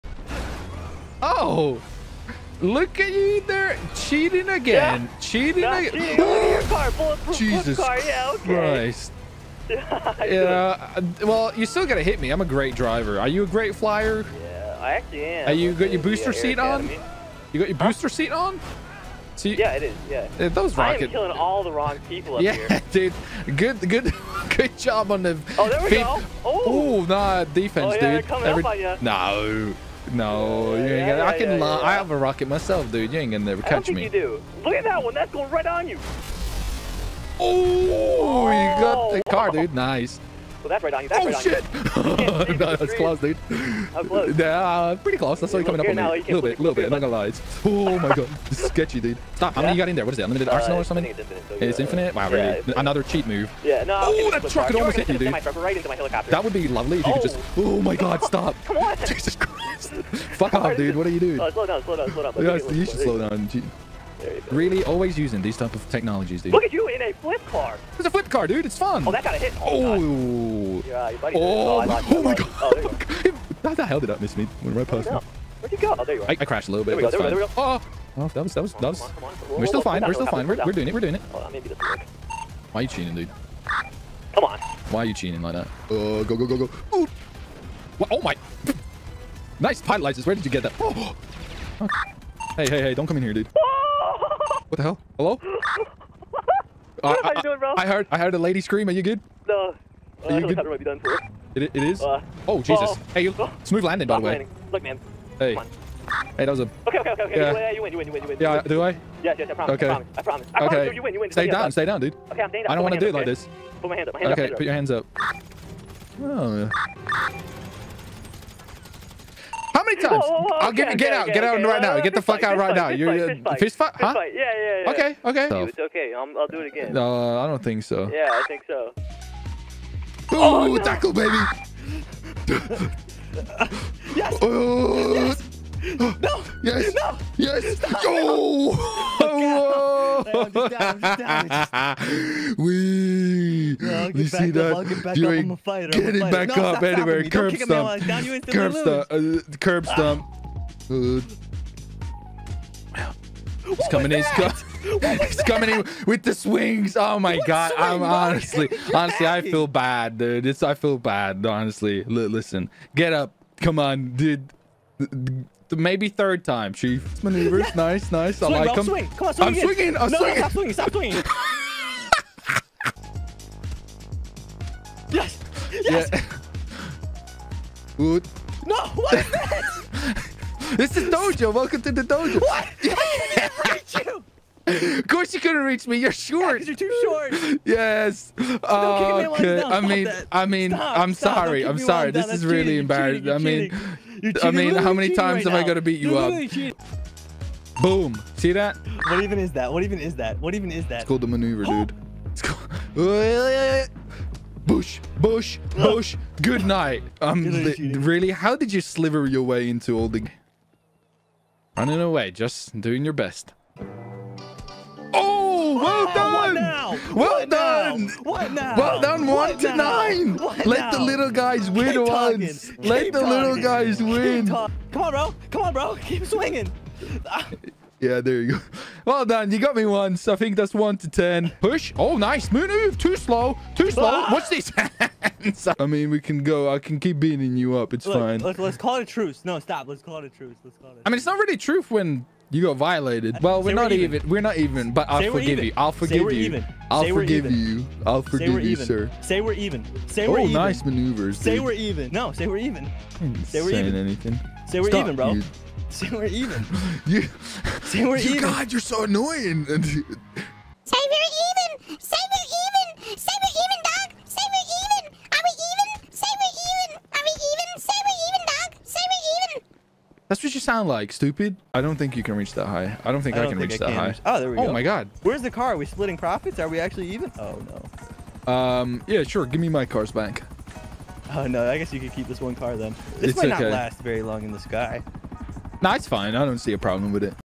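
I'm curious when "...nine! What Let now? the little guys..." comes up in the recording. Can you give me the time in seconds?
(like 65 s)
219 s.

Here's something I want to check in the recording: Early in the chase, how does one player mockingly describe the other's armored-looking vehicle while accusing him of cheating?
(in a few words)
Bulletproof Jesus car.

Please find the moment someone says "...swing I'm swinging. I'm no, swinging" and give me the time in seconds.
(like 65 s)
169 s.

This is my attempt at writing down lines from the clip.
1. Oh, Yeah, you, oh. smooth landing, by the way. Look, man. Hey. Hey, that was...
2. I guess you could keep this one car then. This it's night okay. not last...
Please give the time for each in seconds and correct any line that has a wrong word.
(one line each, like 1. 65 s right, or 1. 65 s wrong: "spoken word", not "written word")
1. 102 s wrong: "Hey", not "Yeah"
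2. 281 s wrong: "might", not "night".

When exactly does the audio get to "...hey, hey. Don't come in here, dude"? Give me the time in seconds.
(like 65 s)
92 s.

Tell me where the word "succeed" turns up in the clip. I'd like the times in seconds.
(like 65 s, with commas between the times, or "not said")
not said.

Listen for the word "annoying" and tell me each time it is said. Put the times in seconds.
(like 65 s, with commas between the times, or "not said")
259 s.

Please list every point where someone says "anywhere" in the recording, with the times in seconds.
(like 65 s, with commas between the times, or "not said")
146 s.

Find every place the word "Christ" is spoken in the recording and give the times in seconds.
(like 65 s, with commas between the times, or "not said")
8 s, 59 s.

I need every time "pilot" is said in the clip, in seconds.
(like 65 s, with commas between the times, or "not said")
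89 s.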